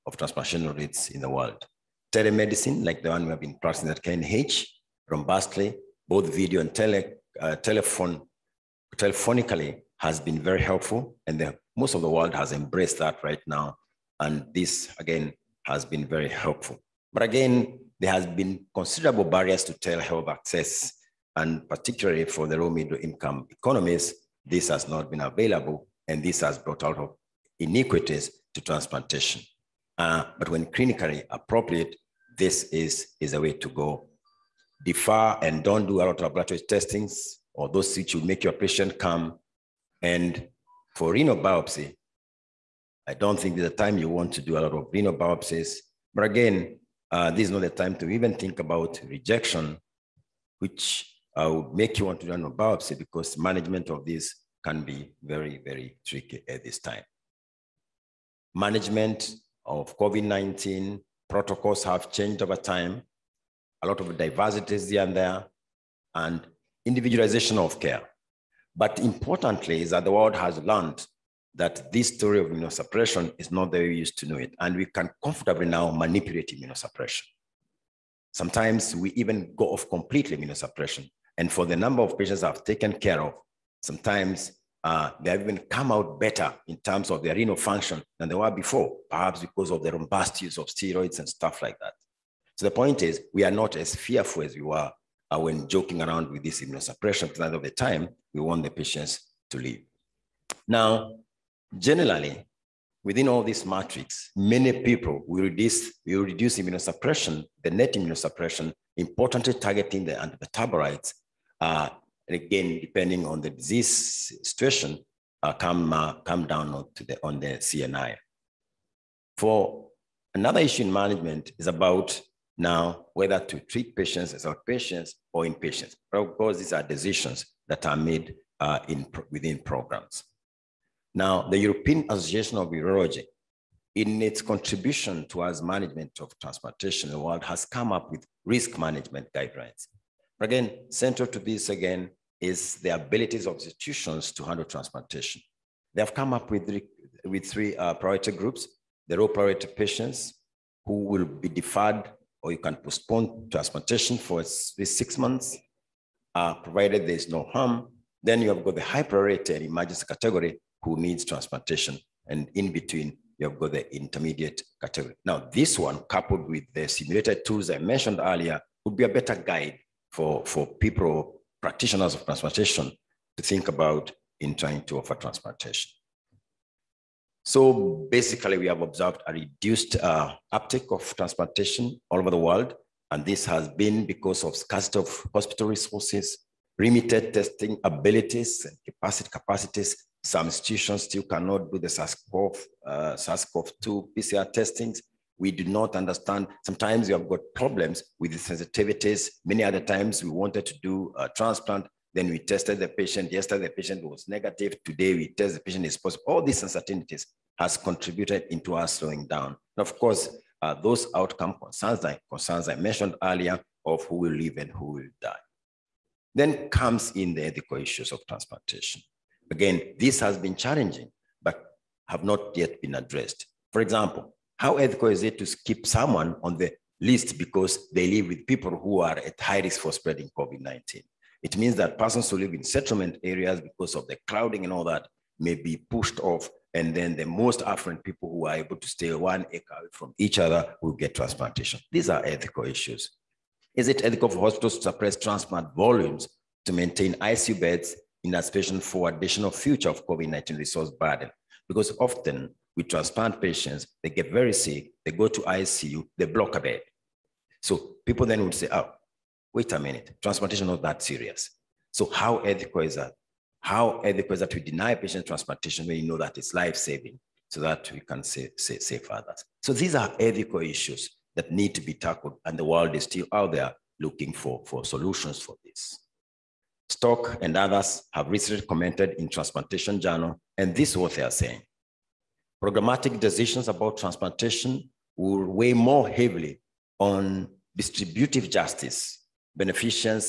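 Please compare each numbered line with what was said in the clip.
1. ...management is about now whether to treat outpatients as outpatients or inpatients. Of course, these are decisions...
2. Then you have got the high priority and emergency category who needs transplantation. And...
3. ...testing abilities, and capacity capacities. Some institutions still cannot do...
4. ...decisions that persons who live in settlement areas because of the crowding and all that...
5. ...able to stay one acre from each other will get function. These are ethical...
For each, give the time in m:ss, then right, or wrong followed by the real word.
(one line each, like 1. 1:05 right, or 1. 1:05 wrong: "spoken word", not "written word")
1. 2:00 wrong: "patients", not "outpatients"
2. 2:38 right
3. 3:07 right
4. 3:51 wrong: "means", not "decisions"
5. 3:58 wrong: "transplantation", not "function".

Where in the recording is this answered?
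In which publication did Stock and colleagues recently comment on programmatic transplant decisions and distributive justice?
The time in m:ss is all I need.
4:39.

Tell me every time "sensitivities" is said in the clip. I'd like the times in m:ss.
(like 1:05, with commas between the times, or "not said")
3:18.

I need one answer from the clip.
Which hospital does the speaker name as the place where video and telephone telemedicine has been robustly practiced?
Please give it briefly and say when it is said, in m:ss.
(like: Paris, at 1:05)
KNH, at 0:04.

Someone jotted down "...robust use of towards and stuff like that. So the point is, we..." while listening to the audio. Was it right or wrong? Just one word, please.
wrong.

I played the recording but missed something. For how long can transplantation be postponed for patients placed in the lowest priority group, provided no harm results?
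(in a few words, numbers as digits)
6 months.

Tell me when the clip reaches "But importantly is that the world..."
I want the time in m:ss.
1:08.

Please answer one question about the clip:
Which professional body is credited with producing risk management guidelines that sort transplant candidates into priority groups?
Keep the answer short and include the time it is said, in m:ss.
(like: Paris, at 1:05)
European Association of Urology, at 2:11.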